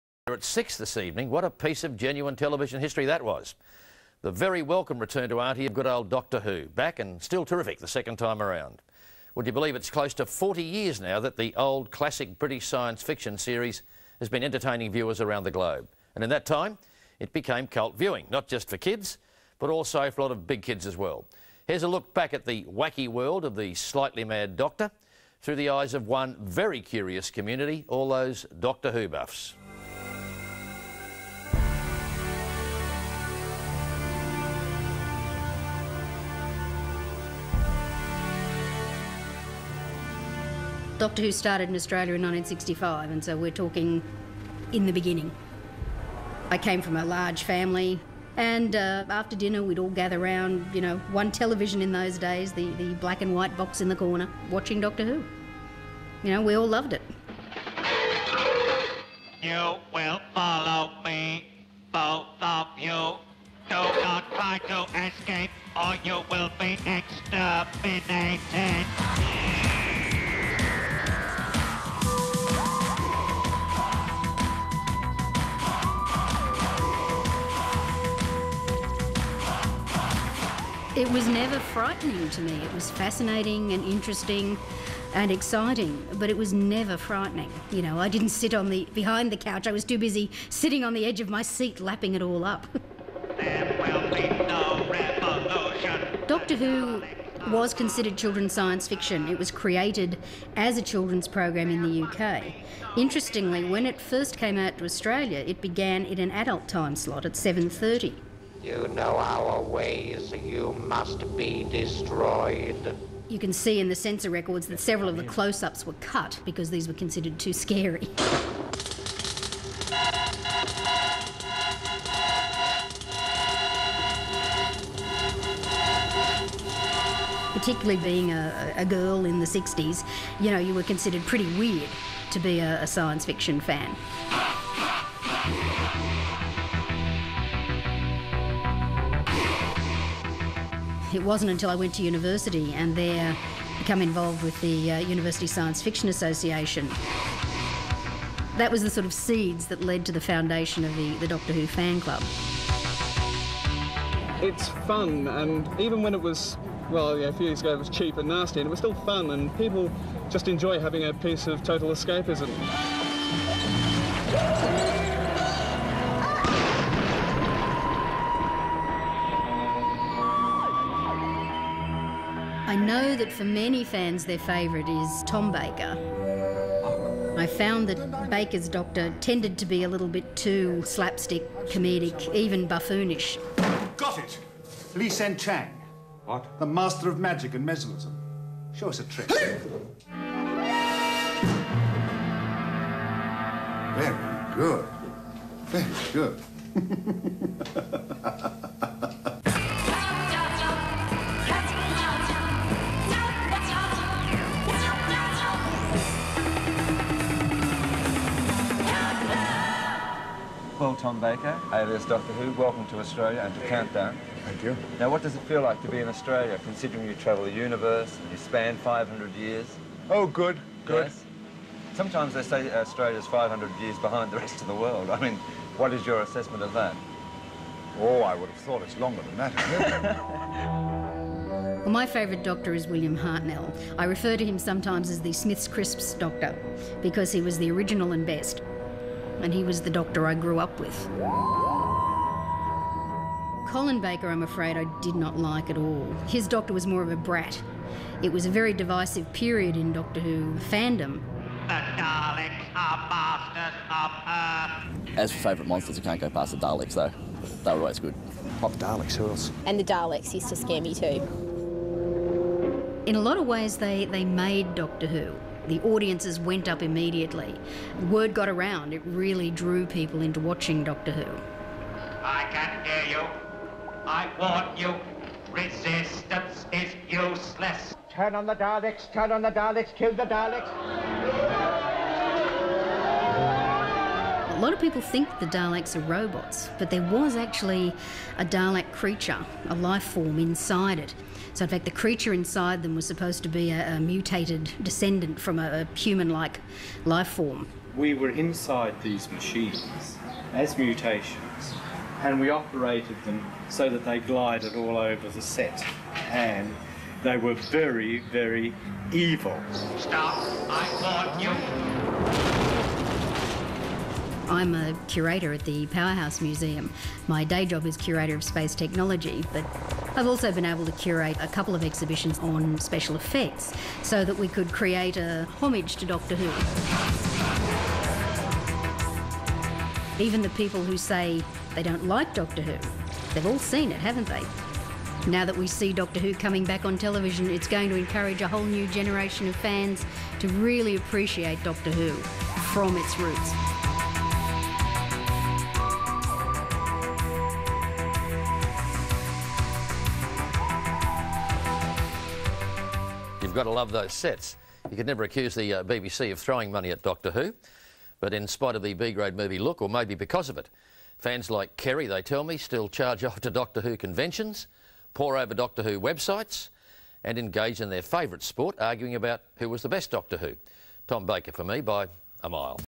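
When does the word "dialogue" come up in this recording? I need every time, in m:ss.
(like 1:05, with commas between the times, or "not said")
not said.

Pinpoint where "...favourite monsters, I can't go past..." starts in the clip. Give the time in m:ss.
4:15.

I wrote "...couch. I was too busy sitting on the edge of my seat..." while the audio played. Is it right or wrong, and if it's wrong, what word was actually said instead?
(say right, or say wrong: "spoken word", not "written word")
right.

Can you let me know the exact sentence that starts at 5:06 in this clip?
And they were very, very evil.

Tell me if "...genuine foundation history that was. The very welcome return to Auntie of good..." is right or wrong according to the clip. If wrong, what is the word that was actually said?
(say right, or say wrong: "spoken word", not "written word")
wrong: "television", not "foundation".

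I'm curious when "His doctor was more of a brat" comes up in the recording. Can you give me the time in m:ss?
4:06.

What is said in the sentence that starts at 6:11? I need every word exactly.
Tom Baker for me by a mile.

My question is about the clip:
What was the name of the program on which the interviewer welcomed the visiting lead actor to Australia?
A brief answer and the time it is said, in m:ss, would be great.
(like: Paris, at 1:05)
Countdown, at 3:33.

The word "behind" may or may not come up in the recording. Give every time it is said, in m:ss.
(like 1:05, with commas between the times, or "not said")
1:28, 3:43.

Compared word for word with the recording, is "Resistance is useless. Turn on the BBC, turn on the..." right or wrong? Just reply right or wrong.
wrong.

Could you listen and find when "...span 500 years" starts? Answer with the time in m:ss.
3:38.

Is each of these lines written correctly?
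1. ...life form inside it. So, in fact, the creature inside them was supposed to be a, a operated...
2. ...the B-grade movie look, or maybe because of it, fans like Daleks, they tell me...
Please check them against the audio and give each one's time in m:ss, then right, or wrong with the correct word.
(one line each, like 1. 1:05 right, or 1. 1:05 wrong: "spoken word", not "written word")
1. 4:49 wrong: "mutated", not "operated"
2. 5:58 wrong: "Kerry", not "Daleks".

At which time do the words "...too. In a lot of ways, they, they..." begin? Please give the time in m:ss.
4:20.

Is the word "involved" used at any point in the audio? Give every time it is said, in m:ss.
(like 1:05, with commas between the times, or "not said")
2:24.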